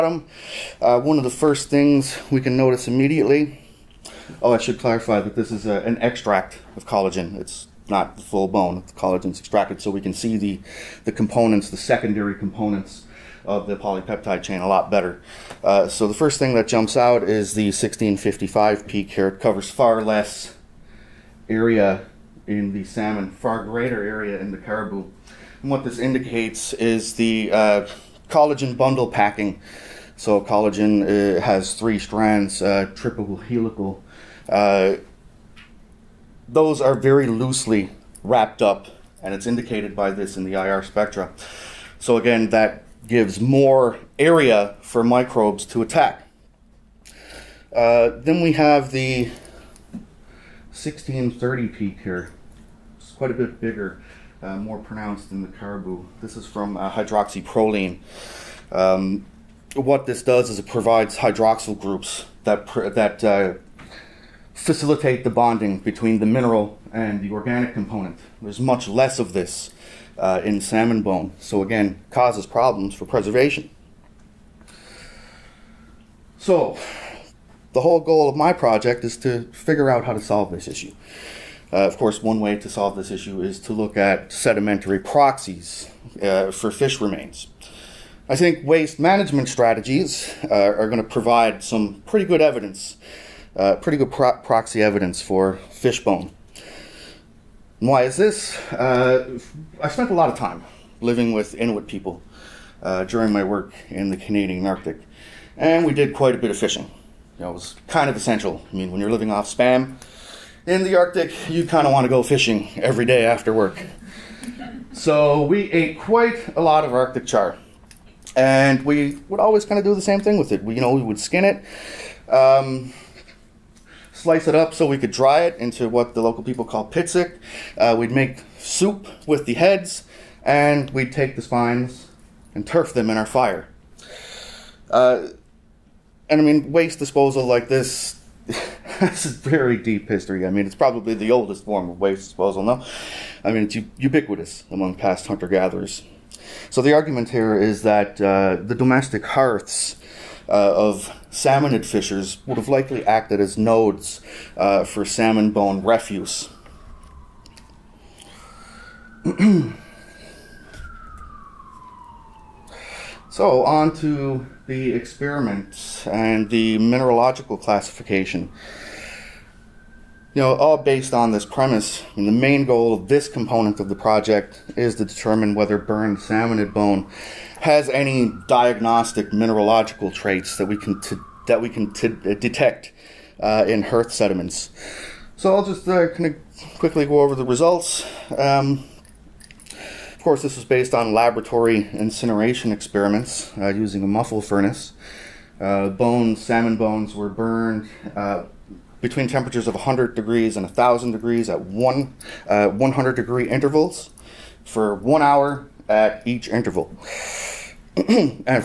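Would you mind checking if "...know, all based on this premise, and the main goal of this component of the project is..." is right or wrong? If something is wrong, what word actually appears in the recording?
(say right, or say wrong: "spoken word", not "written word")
right.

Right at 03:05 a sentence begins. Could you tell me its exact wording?
So I'll just uh, kind of quickly go over the results.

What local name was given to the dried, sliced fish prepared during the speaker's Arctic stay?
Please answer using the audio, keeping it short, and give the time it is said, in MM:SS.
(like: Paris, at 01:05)
pitsik, at 02:06.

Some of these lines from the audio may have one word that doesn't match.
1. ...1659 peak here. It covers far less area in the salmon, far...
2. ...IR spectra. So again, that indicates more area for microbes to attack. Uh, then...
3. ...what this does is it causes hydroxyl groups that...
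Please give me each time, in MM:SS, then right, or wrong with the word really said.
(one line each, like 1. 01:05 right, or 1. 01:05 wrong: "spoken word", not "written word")
1. 00:17 wrong: "1655", not "1659"
2. 00:40 wrong: "gives", not "indicates"
3. 00:59 wrong: "provides", not "causes".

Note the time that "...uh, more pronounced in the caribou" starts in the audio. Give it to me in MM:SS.
00:54.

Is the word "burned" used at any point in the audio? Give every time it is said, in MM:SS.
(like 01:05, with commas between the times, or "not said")
02:55, 03:17.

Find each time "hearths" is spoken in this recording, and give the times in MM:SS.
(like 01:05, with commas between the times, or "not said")
02:29, 03:03.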